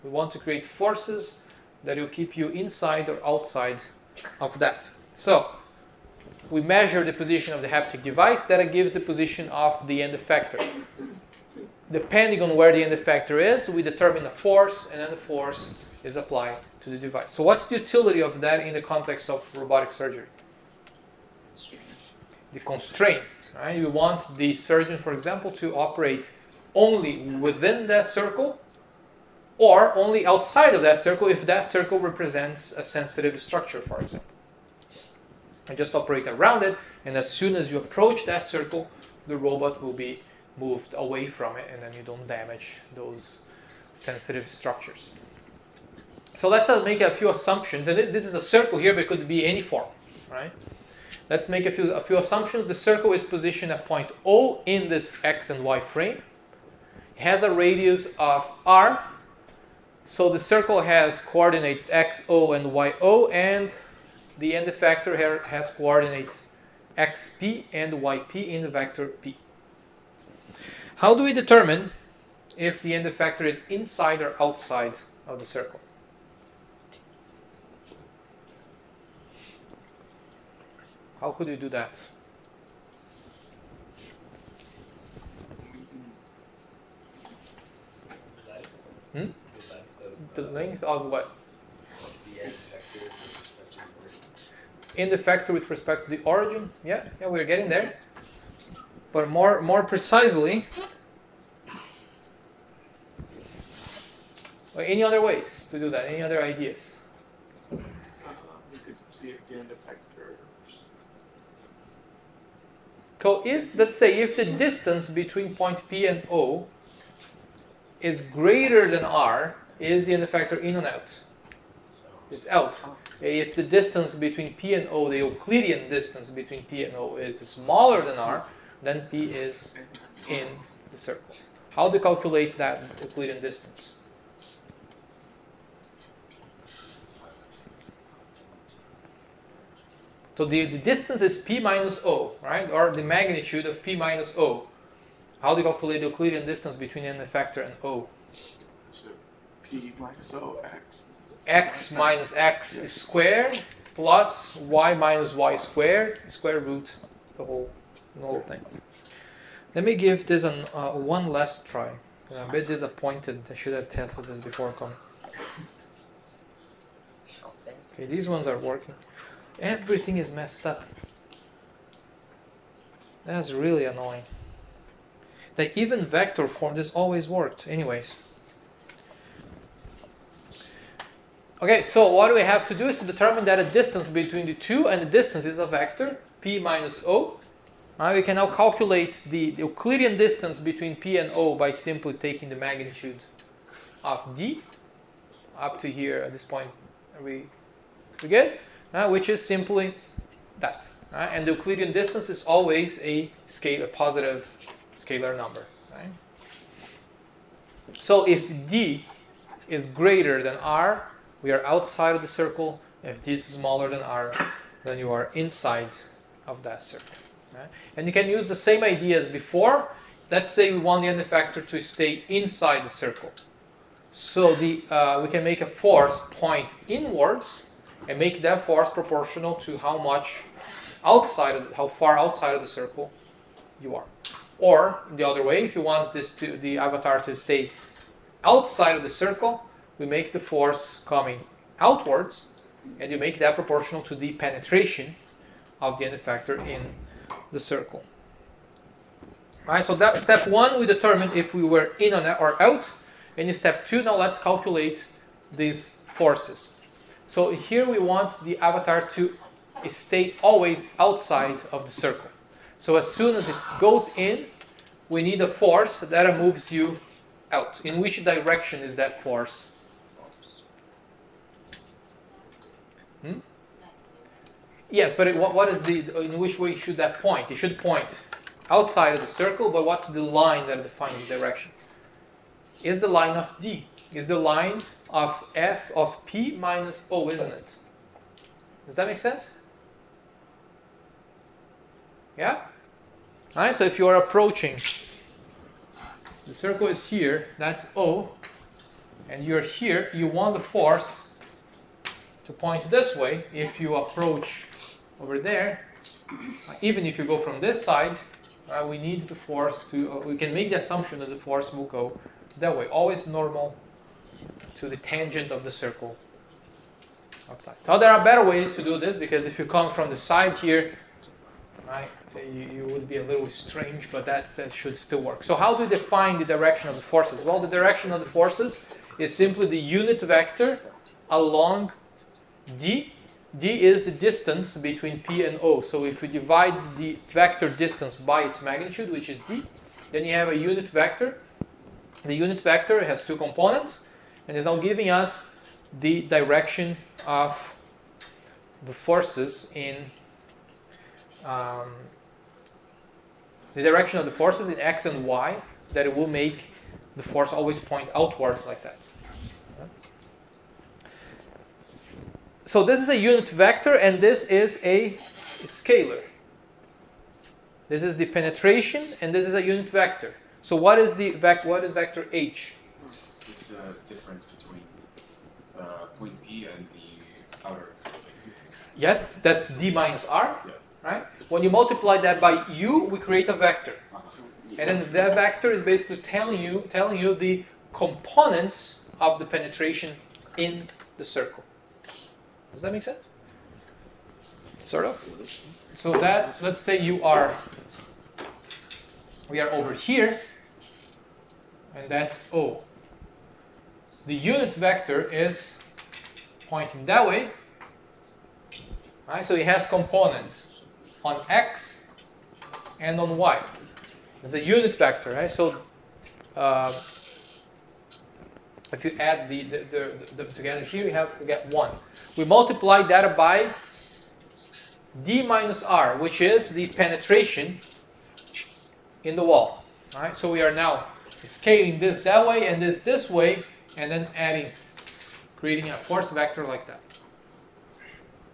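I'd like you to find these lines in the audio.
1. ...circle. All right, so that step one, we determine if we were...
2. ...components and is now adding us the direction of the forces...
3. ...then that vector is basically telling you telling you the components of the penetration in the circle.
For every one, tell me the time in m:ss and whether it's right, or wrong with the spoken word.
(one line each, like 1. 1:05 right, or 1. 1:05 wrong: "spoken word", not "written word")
1. 4:07 right
2. 5:43 wrong: "giving", not "adding"
3. 6:24 right.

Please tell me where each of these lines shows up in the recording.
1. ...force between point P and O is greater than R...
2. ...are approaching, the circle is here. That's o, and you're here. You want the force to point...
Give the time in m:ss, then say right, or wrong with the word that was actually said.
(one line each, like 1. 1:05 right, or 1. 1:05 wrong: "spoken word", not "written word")
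1. 1:54 wrong: "distance", not "force"
2. 4:54 right.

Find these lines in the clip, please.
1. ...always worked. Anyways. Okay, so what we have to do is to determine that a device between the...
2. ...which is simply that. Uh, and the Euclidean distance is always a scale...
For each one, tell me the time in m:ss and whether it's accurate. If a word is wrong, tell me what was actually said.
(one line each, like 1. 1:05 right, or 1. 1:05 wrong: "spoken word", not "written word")
1. 2:56 wrong: "distance", not "device"
2. 3:19 right.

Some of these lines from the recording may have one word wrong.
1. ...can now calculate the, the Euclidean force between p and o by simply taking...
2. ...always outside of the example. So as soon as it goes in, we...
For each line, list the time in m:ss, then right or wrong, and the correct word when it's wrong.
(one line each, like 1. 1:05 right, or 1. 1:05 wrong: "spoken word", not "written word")
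1. 3:08 wrong: "distance", not "force"
2. 4:20 wrong: "circle", not "example".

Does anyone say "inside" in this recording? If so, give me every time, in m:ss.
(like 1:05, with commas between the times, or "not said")
0:02, 1:13, 3:35, 3:42.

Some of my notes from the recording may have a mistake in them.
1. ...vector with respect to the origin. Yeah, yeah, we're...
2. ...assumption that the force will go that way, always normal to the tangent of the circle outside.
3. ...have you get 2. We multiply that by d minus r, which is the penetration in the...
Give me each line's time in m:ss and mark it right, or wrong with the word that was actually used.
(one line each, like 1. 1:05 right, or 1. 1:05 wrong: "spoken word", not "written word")
1. 1:35 wrong: "factor", not "vector"
2. 5:10 right
3. 7:01 wrong: "1", not "2".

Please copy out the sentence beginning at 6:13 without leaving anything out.
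It's the difference between uh, point P and the outer.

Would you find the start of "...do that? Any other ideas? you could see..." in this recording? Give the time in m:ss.
1:45.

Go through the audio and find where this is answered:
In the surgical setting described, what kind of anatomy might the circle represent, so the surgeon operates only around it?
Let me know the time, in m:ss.
0:32.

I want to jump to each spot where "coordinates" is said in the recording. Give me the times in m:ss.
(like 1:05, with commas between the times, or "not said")
1:01, 1:05.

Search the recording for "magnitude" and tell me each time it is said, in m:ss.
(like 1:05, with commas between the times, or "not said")
2:23, 3:12, 5:38.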